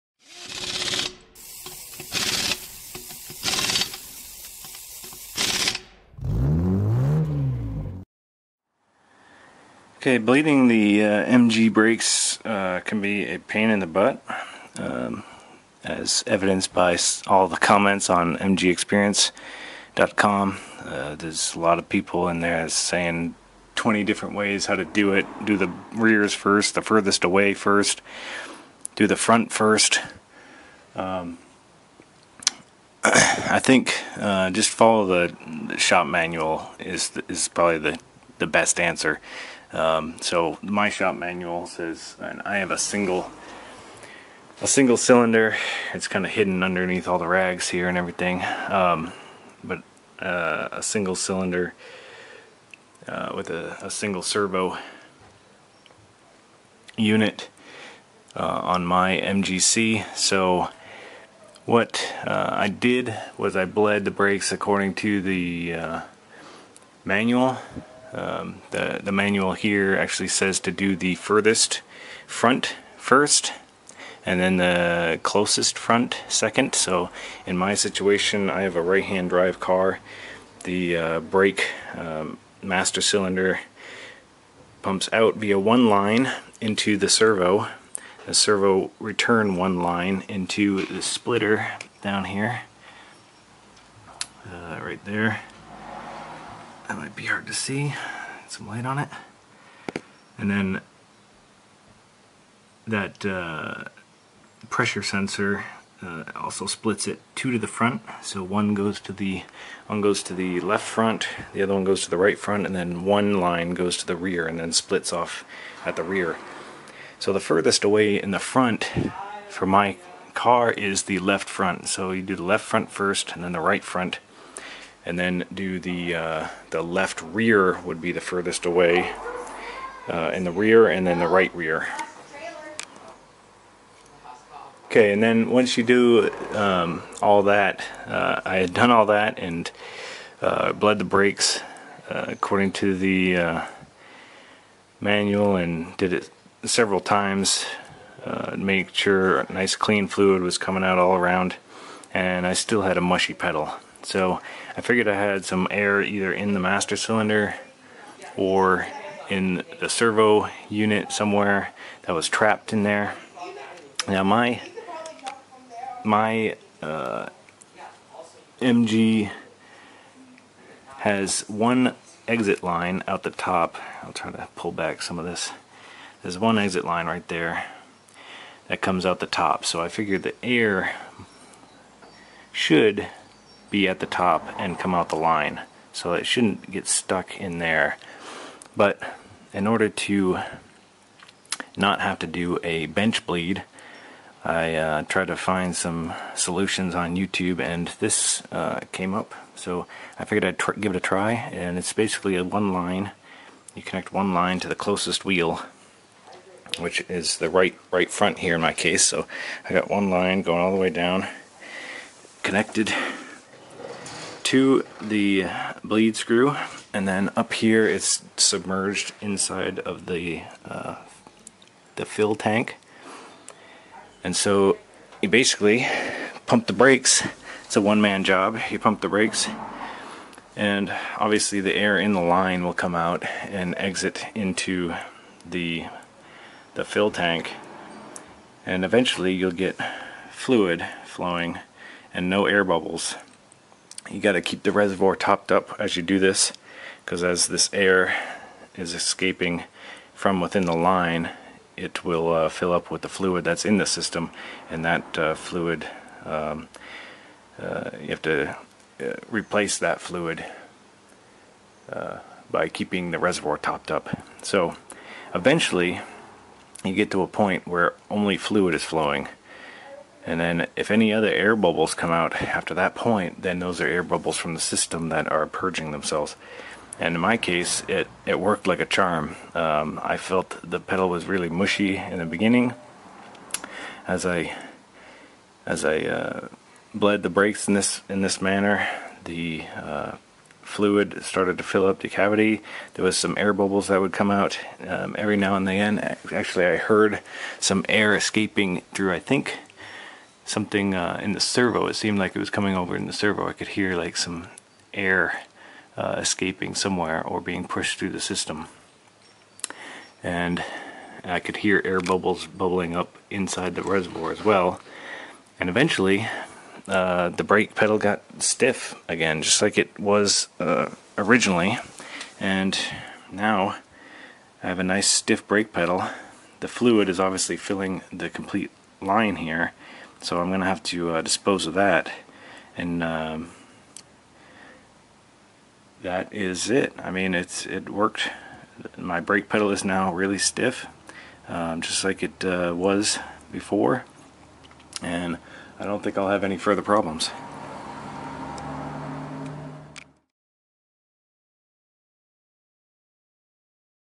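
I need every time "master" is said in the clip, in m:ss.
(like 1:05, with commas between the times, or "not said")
1:22, 2:36.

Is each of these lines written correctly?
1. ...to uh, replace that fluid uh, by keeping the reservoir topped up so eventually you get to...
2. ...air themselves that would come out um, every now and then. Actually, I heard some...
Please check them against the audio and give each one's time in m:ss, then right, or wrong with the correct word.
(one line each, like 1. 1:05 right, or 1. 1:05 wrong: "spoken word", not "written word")
1. 4:18 right
2. 4:53 wrong: "bubbles", not "themselves".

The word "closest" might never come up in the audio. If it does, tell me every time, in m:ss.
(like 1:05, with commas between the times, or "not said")
1:15, 3:24.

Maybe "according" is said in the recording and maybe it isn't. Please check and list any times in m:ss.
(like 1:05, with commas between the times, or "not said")
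1:04, 2:22.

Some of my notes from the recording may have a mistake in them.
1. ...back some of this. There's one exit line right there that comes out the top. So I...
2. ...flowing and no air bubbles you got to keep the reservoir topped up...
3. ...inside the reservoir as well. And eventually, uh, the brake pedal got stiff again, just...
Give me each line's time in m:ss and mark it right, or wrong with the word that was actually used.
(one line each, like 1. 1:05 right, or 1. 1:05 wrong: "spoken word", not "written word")
1. 2:54 right
2. 4:01 right
3. 5:13 right.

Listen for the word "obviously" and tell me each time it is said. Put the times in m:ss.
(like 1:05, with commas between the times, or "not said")
3:51, 5:27.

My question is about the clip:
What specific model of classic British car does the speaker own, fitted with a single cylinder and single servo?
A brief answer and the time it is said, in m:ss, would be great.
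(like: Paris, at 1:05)
MGC, at 0:59.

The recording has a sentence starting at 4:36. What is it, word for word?
And in my case, it, it worked like a charm.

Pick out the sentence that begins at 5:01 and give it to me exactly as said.
It seemed like it was coming over in the servo.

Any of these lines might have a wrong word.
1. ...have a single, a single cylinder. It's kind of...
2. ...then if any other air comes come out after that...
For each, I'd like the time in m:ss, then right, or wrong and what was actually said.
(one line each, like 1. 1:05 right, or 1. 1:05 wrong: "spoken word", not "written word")
1. 0:42 right
2. 4:30 wrong: "bubbles", not "comes".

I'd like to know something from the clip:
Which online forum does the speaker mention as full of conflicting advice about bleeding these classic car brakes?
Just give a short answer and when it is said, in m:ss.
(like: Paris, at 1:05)
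MGExperience.com, at 0:18.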